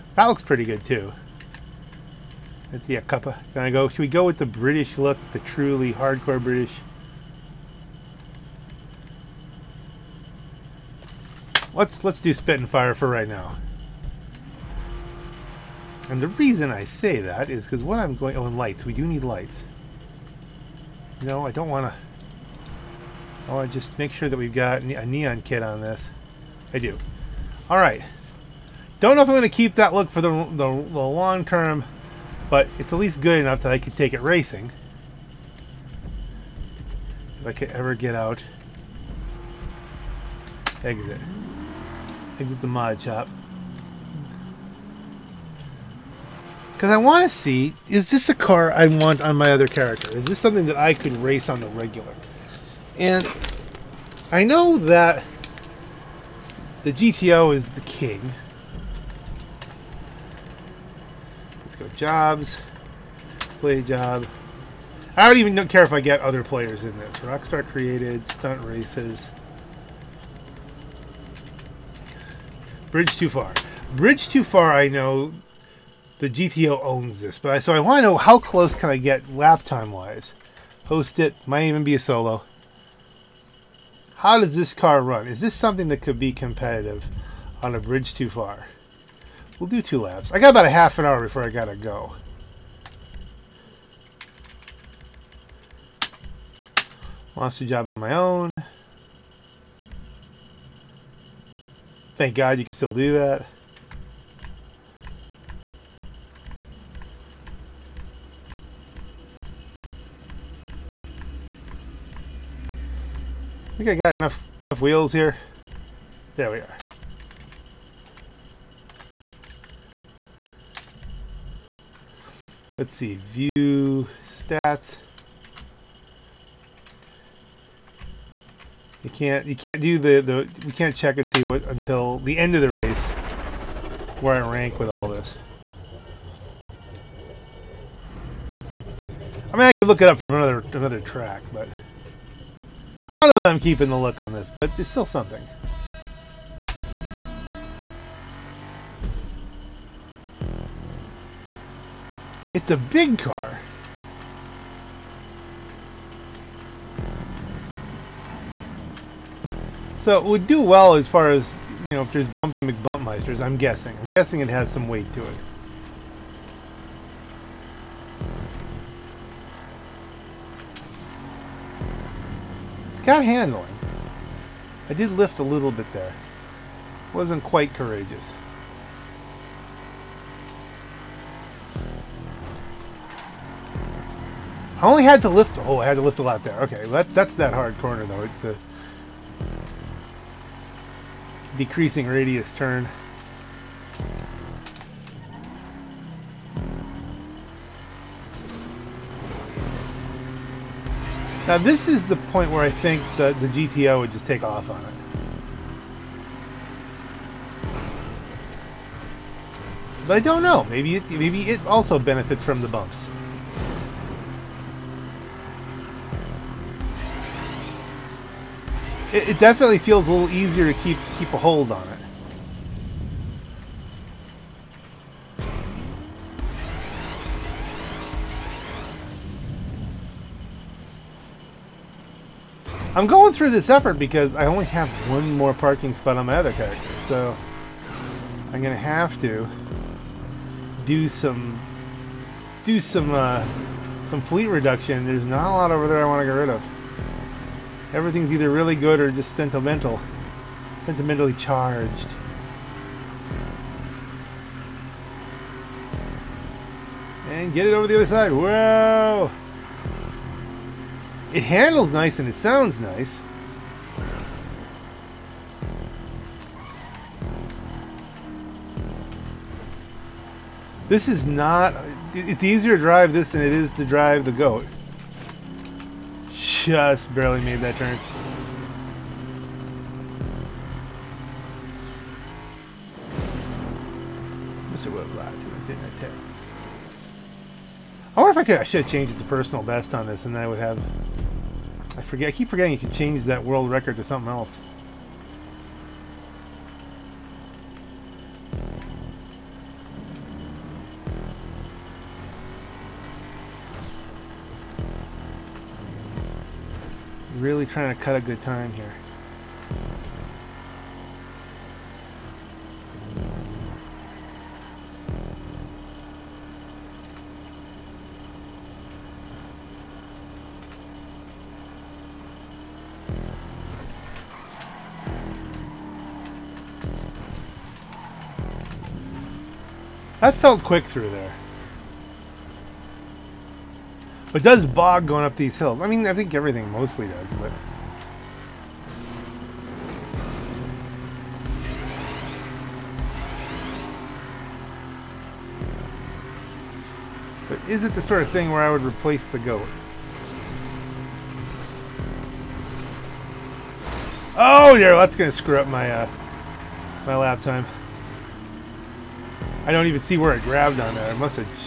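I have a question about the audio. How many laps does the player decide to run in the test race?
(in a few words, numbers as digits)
2.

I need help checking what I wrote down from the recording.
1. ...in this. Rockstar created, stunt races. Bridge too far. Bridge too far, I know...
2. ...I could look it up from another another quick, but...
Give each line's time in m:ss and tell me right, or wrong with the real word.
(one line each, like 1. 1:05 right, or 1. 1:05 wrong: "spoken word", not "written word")
1. 1:06 right
2. 2:19 wrong: "track", not "quick".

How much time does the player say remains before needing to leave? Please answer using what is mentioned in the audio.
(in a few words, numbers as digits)
Half an hour.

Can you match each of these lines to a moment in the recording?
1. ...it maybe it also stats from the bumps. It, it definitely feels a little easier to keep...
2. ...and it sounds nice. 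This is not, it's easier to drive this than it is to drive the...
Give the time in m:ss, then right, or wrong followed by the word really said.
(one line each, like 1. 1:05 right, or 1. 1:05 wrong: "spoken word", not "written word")
1. 3:30 wrong: "benefits", not "stats"
2. 4:22 right.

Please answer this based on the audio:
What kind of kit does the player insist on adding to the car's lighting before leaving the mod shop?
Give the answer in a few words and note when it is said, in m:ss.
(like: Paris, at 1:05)
Neon kit, at 0:25.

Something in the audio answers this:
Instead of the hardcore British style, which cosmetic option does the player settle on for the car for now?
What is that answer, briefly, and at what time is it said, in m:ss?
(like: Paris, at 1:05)
Spit and fire, at 0:12.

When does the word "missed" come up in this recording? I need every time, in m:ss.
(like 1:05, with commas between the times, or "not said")
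not said.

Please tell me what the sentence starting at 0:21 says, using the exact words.
You know, I don't want to...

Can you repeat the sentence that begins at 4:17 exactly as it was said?
And get it over the other side.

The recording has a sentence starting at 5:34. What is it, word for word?
But does bog going up these hills.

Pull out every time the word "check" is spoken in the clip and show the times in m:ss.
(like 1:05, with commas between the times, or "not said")
2:10.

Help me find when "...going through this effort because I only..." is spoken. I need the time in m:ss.
3:53.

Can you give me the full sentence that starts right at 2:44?
I'm guessing it has some weight to it.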